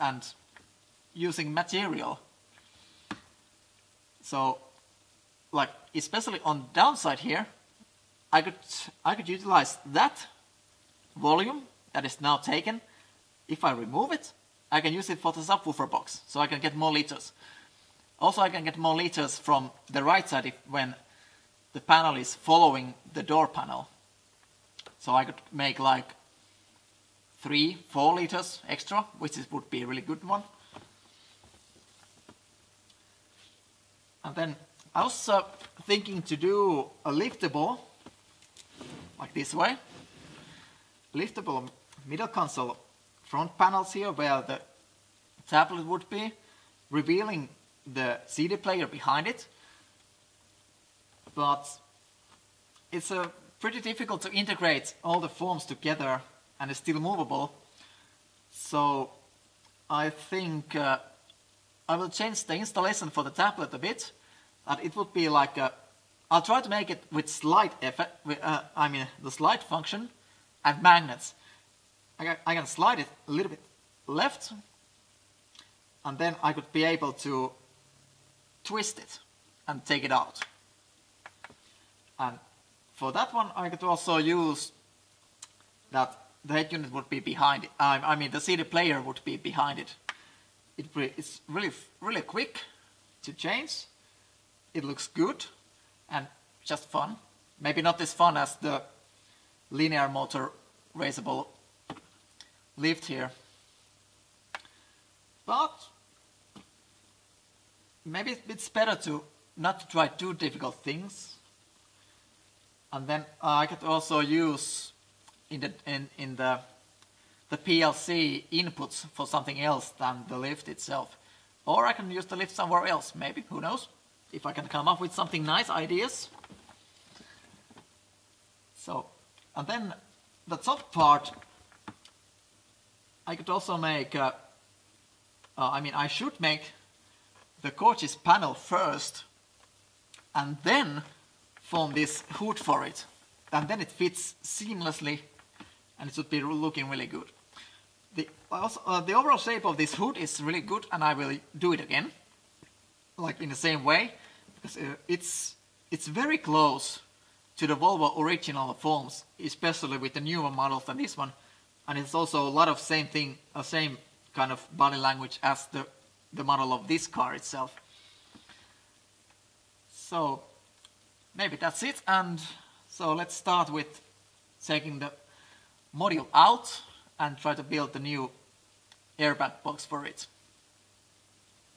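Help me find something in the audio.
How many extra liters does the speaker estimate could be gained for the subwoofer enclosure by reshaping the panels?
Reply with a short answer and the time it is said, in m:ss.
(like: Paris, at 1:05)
3-4, at 0:27.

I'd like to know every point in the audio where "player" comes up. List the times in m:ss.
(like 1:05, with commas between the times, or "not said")
0:48, 1:28.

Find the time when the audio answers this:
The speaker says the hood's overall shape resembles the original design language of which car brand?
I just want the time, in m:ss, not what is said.
2:37.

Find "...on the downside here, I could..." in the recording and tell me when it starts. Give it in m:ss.
0:06.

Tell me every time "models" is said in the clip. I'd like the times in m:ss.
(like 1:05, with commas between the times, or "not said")
2:40, 2:46.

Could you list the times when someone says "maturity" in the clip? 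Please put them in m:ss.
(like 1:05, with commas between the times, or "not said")
not said.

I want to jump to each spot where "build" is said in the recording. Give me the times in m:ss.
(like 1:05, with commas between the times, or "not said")
2:57.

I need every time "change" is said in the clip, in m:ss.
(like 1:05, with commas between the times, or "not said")
1:02, 1:33.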